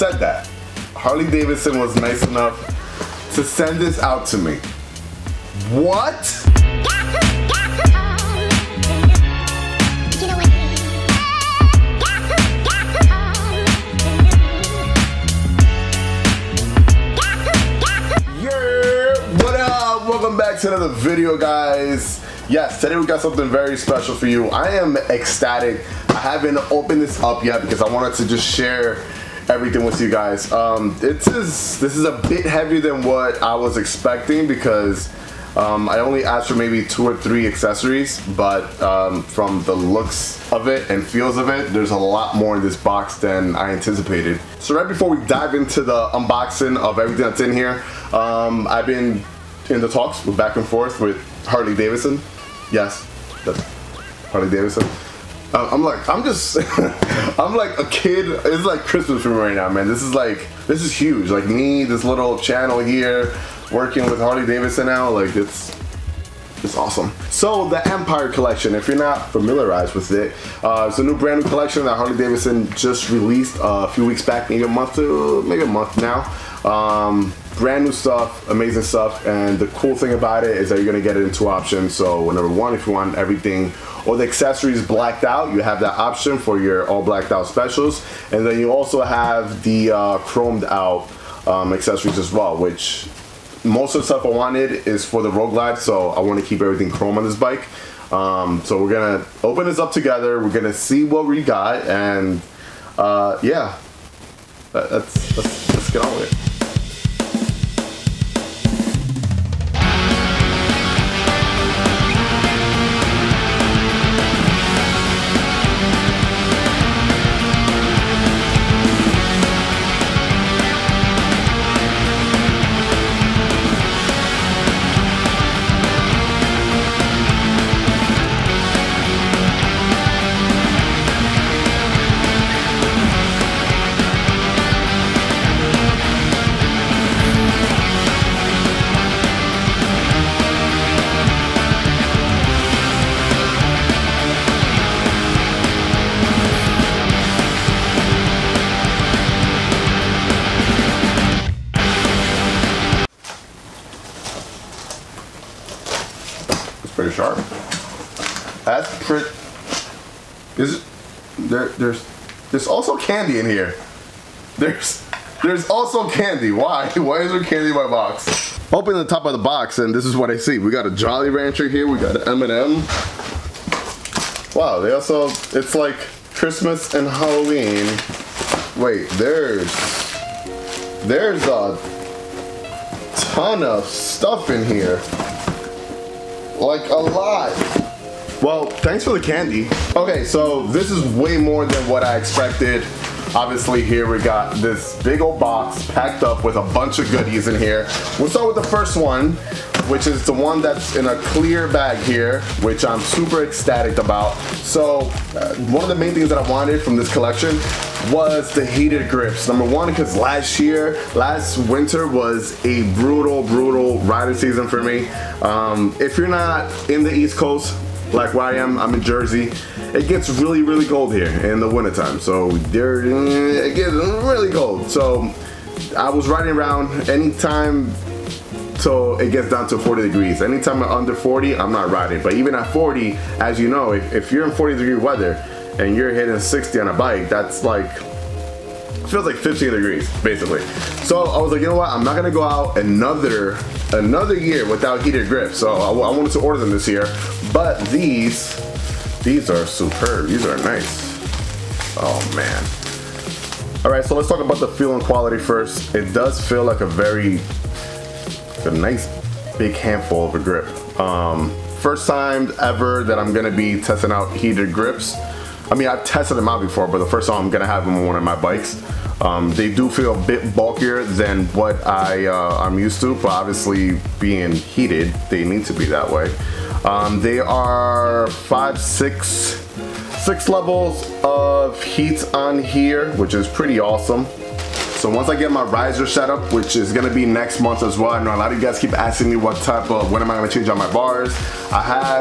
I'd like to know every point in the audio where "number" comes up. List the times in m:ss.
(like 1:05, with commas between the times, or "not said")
1:22, 3:29.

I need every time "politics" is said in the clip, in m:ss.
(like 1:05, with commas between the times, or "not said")
not said.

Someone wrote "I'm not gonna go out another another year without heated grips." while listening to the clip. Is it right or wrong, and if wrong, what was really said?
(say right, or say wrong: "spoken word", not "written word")
right.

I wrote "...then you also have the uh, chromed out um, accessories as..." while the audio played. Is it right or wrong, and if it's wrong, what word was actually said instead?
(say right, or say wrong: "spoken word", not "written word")
right.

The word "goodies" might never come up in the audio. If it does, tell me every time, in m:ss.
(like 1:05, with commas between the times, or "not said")
3:17.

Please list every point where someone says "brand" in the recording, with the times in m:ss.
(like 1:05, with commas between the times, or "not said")
1:11, 1:17.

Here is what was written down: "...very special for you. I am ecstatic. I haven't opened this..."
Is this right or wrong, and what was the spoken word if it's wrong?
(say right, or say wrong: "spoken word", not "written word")
right.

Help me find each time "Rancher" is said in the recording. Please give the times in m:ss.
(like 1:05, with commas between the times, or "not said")
2:51.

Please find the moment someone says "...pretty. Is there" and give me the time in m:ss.
2:39.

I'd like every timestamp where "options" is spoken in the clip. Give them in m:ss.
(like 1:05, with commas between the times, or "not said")
1:21, 1:25.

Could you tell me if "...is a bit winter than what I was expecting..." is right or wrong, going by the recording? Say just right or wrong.
wrong.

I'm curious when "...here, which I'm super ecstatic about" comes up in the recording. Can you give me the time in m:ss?
3:22.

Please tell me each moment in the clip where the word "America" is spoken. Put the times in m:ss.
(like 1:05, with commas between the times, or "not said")
not said.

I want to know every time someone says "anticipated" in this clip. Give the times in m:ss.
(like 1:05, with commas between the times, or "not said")
0:43.